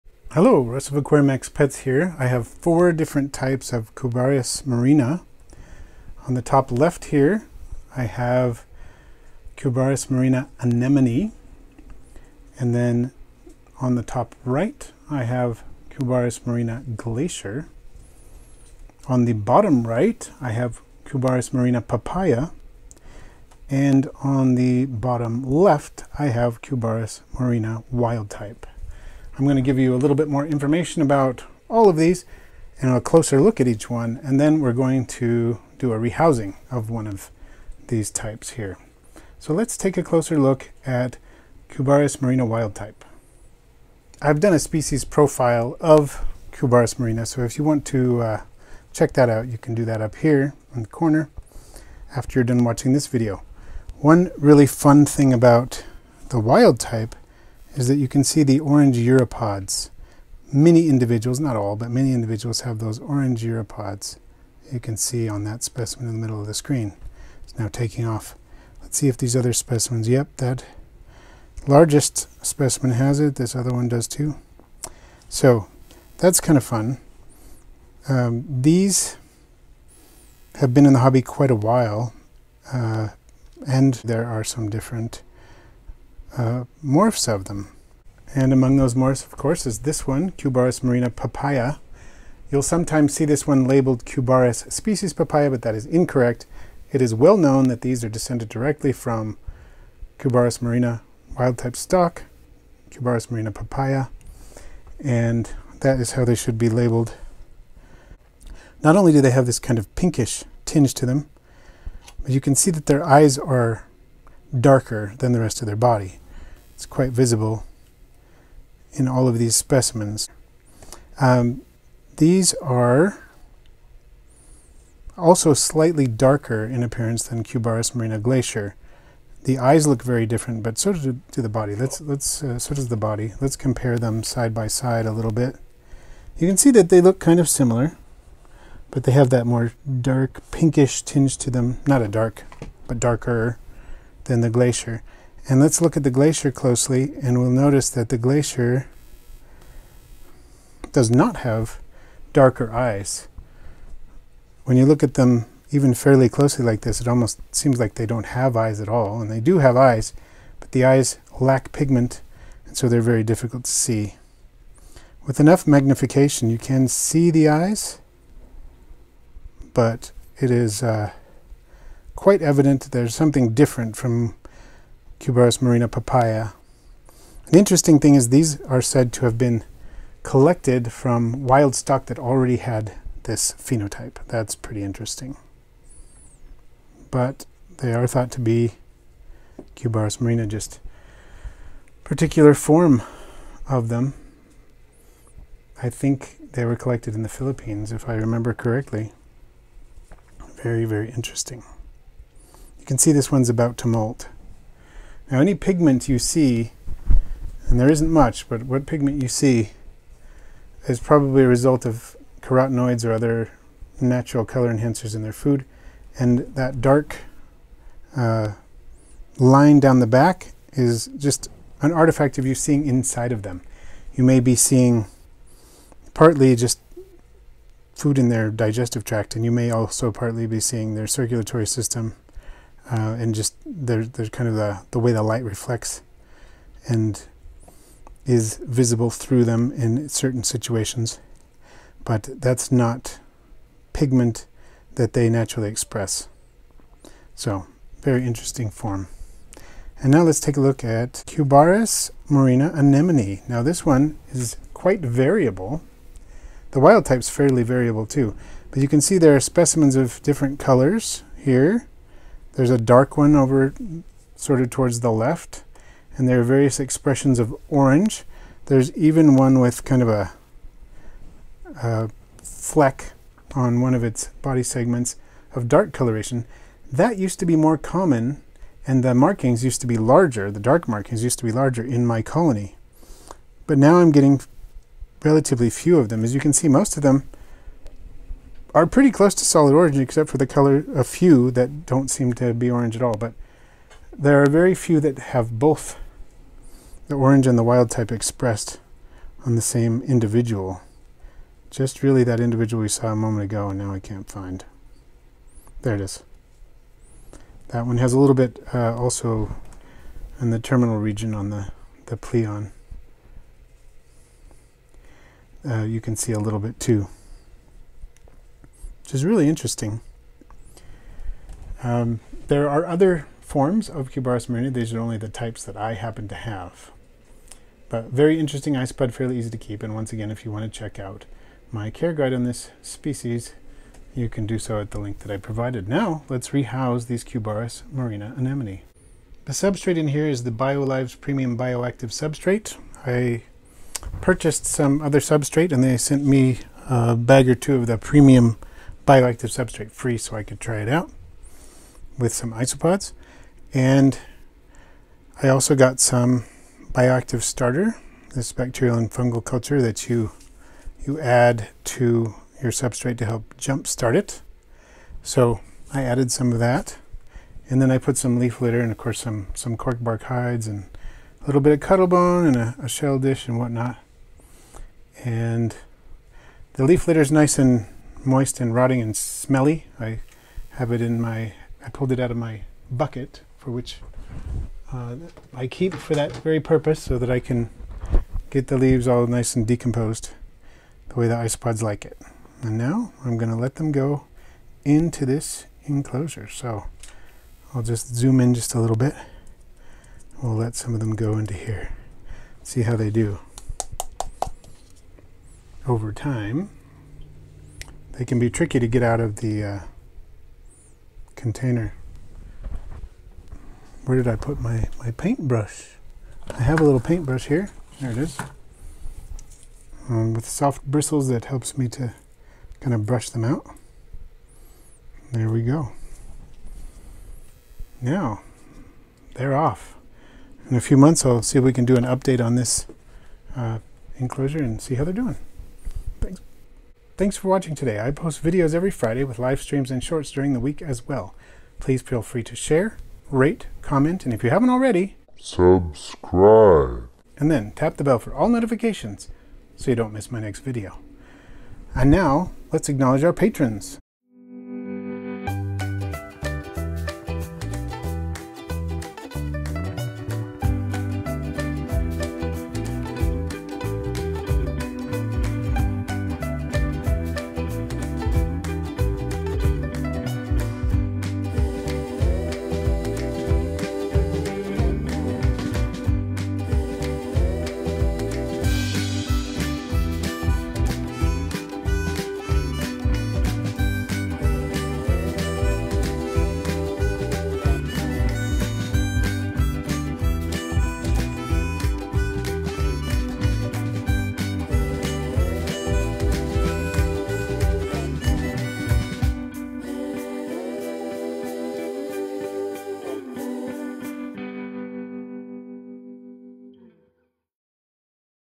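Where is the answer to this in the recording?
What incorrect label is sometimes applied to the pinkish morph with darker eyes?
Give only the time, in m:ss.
1:34.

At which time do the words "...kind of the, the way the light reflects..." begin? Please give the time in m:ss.
3:54.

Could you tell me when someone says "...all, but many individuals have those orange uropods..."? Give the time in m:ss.
1:01.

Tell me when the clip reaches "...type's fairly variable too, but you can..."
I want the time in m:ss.
4:17.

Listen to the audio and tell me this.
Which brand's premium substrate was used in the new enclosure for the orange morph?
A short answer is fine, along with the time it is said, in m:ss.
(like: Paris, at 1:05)
BioLive, at 5:40.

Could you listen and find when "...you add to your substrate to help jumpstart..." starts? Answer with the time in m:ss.
6:01.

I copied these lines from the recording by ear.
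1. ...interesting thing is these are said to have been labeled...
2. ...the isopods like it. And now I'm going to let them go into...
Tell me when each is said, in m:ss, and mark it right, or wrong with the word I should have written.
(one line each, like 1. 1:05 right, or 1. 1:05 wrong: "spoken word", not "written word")
1. 2:57 wrong: "collected", not "labeled"
2. 6:31 right.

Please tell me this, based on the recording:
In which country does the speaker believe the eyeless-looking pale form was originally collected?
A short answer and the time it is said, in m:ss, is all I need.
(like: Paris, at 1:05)
Philippines, at 3:17.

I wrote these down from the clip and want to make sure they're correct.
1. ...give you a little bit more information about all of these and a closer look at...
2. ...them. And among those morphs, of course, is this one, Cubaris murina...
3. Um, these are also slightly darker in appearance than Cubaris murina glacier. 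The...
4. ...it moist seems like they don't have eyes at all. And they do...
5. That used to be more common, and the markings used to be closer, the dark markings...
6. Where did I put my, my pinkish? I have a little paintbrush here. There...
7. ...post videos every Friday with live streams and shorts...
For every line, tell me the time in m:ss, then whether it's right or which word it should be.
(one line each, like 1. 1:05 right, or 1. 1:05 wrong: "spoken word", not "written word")
1. 0:29 right
2. 1:27 right
3. 2:01 right
4. 2:37 wrong: "almost", not "moist"
5. 4:36 wrong: "larger", not "closer"
6. 6:54 wrong: "paintbrush", not "pinkish"
7. 7:18 right.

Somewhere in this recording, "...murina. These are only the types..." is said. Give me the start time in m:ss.
5:24.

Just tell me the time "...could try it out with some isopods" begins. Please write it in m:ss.
5:50.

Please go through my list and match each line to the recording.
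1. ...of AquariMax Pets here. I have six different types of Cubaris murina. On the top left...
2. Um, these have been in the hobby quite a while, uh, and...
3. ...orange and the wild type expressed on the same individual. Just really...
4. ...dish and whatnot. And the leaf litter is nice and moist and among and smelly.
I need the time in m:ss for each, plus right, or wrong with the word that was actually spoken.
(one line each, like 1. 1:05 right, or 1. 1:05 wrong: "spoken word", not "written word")
1. 0:00 wrong: "four", not "six"
2. 1:18 right
3. 4:57 right
4. 6:13 wrong: "rotting", not "among".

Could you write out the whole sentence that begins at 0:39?
So let's take a closer look at Cubaris murina wild type.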